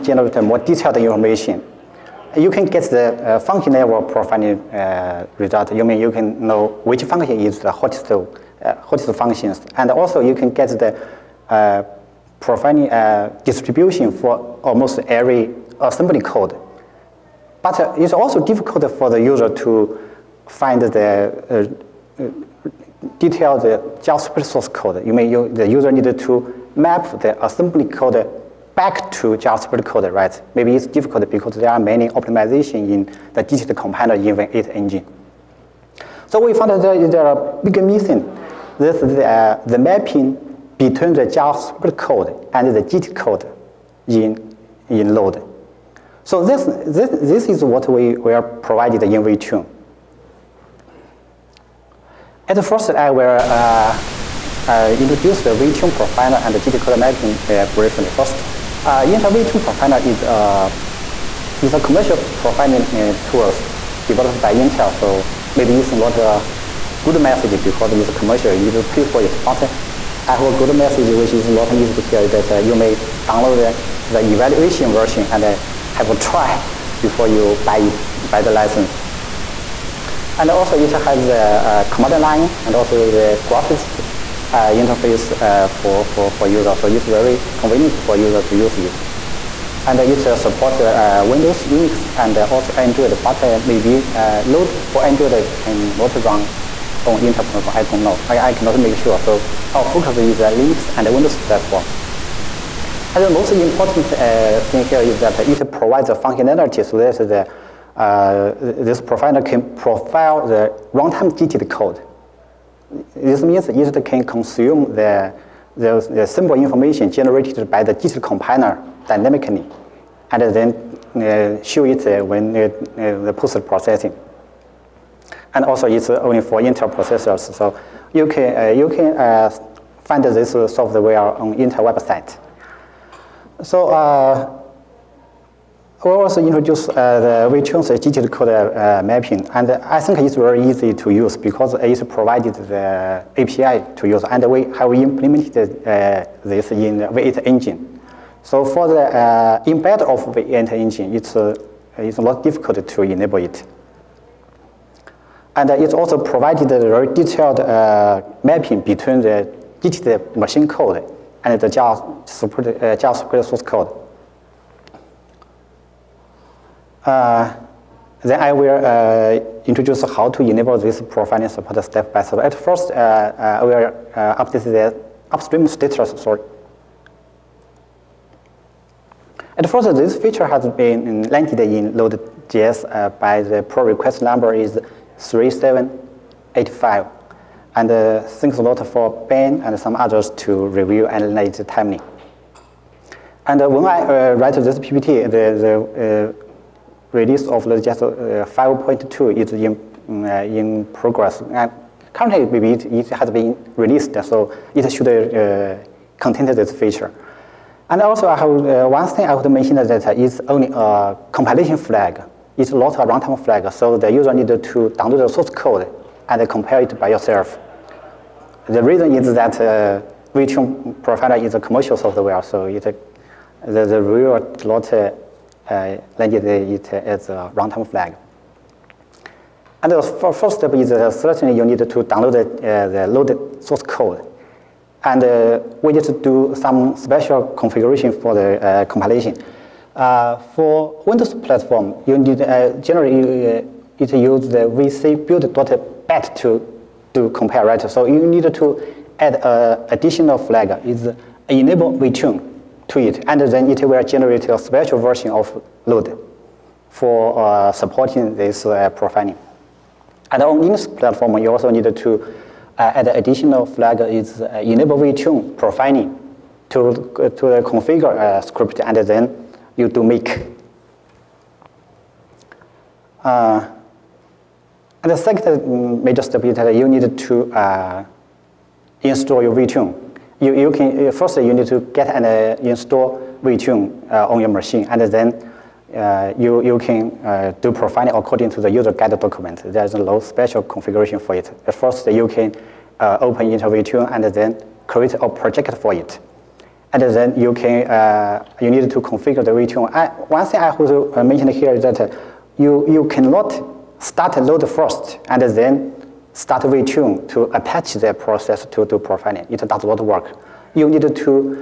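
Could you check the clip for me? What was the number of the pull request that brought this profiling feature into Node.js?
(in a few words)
3785.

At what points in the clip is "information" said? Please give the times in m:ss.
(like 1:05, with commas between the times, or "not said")
0:00, 1:56.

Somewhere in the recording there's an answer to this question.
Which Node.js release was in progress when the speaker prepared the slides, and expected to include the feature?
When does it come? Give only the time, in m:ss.
3:18.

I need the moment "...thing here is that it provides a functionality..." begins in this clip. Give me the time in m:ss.
1:44.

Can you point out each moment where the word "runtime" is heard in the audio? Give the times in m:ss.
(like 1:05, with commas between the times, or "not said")
1:50, 3:32, 3:47.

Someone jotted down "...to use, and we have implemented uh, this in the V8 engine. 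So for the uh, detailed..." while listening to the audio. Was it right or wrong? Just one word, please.
wrong.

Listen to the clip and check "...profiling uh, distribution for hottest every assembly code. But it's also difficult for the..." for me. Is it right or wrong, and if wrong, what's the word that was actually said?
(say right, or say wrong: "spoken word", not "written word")
wrong: "almost", not "hottest".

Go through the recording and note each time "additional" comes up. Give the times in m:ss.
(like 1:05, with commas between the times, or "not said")
4:09, 4:23.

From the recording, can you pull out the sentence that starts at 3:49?
And the first step is uh, certainly you need to download the, uh, the loaded source code.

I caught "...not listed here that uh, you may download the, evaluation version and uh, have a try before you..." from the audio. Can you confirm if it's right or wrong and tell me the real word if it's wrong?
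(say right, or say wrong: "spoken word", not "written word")
right.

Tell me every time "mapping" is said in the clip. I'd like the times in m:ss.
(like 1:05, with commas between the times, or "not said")
0:39, 0:56, 2:19, 2:38.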